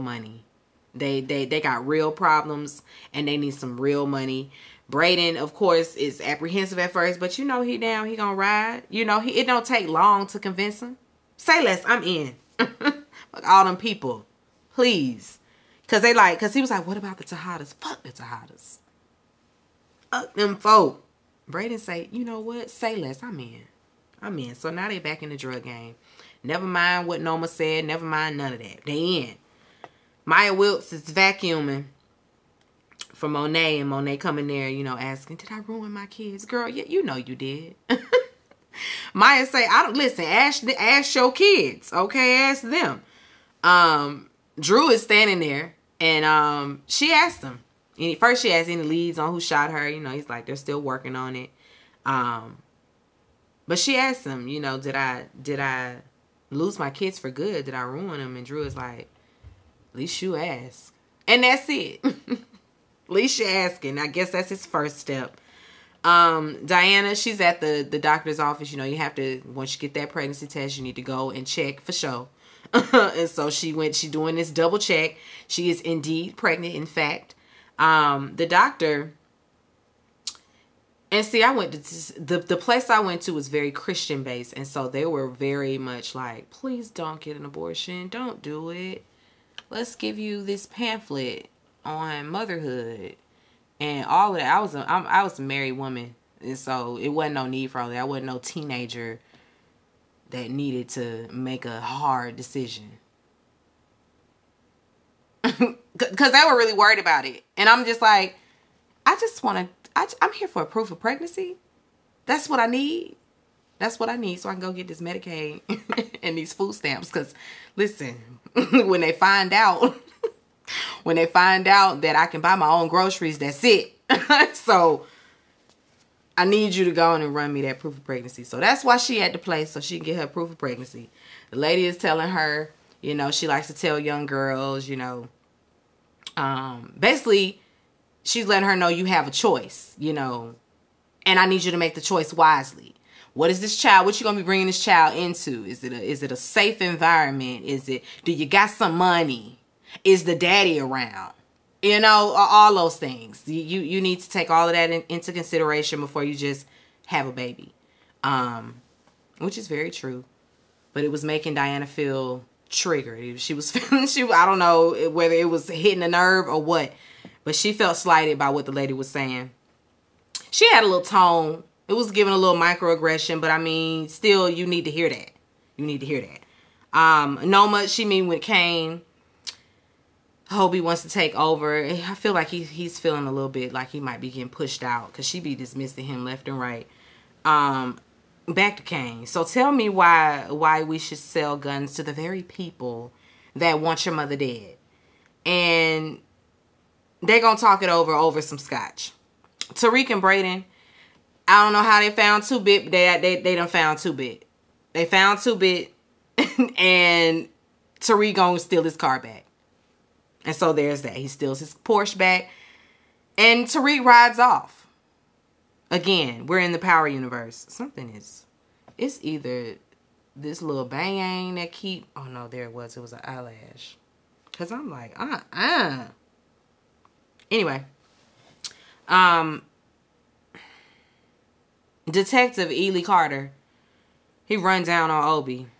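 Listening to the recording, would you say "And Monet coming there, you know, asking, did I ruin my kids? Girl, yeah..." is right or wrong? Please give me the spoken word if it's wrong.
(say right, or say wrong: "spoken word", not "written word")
right.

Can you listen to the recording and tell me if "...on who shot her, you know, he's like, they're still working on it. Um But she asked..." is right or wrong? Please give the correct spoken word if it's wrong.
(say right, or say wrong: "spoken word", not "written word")
right.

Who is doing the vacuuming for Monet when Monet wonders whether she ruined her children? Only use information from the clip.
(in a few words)
Maya Wilkes.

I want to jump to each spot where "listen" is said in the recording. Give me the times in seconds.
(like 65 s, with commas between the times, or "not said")
39 s, 117 s.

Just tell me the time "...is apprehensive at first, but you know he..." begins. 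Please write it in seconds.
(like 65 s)
5 s.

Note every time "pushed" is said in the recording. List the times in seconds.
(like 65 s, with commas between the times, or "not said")
184 s.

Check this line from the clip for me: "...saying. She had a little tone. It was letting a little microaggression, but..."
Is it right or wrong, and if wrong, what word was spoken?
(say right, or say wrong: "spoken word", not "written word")
wrong: "giving", not "letting".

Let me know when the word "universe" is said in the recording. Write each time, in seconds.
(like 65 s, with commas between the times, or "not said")
217 s.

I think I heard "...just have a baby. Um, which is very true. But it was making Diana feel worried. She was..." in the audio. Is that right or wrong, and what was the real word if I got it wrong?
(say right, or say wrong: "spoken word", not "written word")
wrong: "triggered", not "worried".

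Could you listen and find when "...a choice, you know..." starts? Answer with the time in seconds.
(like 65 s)
139 s.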